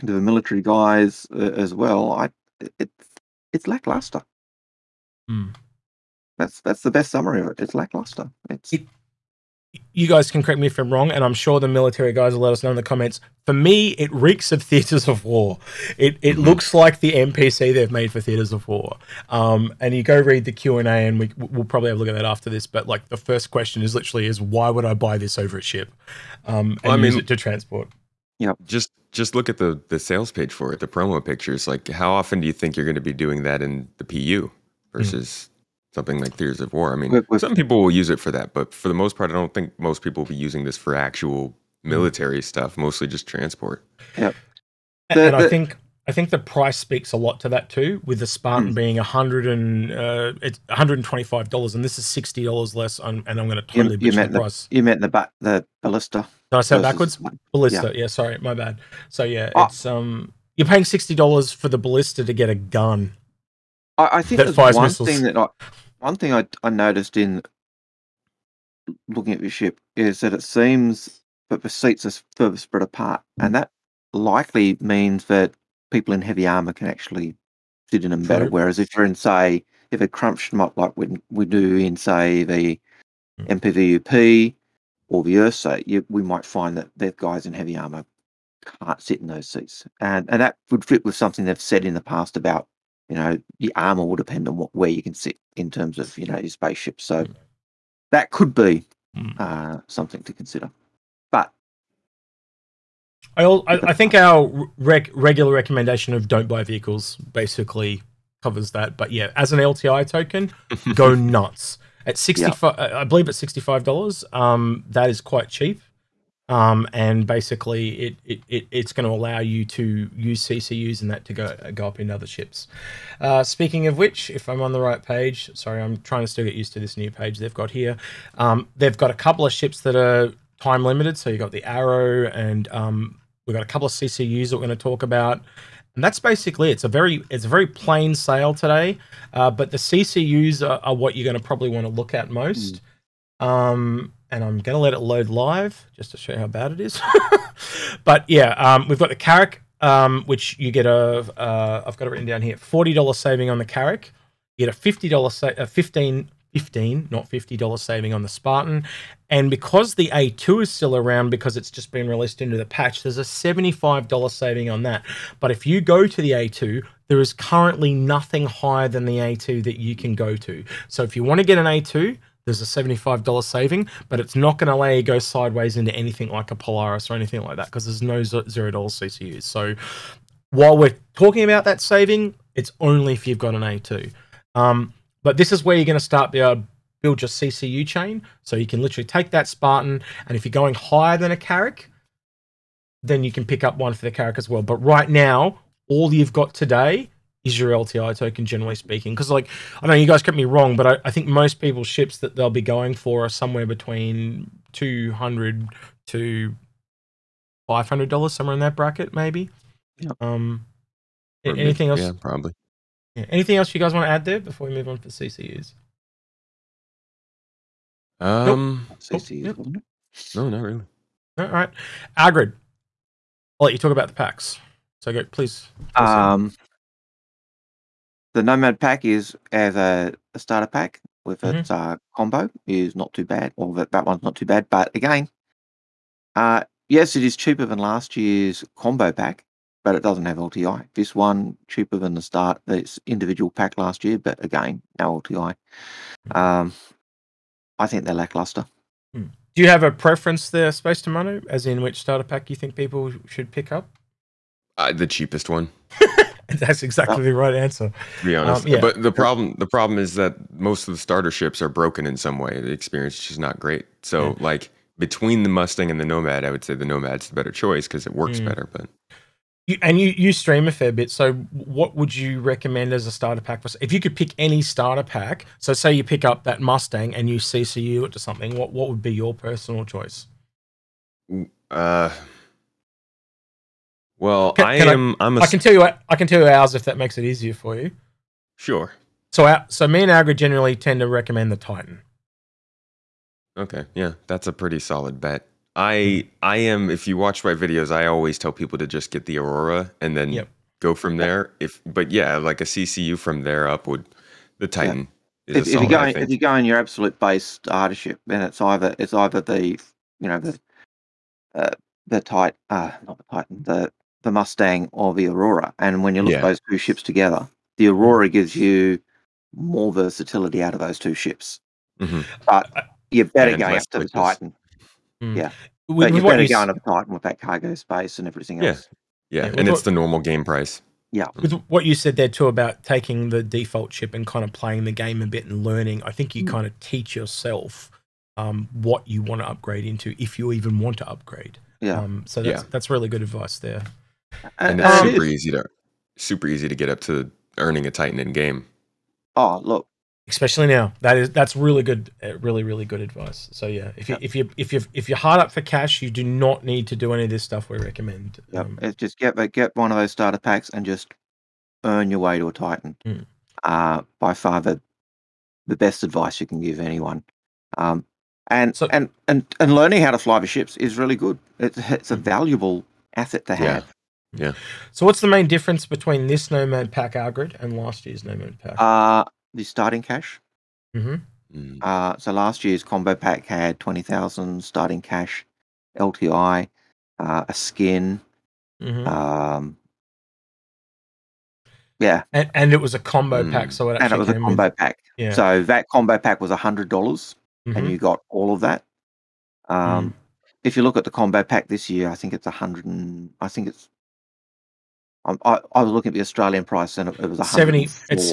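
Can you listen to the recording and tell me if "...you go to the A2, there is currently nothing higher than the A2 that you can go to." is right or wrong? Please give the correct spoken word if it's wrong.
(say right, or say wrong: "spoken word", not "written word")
right.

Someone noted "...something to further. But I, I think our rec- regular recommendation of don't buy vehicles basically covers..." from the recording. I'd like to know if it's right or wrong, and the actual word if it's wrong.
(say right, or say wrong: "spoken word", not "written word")
wrong: "consider", not "further".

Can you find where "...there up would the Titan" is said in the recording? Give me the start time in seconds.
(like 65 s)
303 s.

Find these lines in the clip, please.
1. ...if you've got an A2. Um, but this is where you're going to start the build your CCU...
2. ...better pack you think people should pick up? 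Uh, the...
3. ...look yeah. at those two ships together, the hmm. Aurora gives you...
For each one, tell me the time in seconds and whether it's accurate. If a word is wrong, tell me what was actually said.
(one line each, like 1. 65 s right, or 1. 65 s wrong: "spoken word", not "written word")
1. 183 s right
2. 251 s wrong: "starter", not "better"
3. 316 s right.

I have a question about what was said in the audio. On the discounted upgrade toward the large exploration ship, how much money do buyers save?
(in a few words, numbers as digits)
$40.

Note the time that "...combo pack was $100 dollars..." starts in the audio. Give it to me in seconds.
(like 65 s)
395 s.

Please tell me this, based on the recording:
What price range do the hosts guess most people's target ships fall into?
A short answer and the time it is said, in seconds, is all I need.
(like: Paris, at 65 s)
$200 to $500, at 204 s.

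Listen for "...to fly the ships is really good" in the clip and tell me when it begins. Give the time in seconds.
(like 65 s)
370 s.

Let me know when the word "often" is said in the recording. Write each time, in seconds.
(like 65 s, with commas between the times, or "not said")
32 s.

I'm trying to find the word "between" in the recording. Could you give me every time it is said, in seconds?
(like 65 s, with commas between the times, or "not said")
203 s, 264 s, 375 s.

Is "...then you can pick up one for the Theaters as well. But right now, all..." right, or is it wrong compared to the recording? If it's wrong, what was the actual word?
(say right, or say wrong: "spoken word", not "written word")
wrong: "Carrack", not "Theaters".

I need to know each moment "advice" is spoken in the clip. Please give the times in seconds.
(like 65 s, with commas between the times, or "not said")
343 s, 353 s, 366 s.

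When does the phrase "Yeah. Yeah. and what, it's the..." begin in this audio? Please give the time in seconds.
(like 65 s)
328 s.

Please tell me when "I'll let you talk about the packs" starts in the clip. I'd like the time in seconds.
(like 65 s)
223 s.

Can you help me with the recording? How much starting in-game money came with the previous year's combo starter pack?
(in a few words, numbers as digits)
20,000.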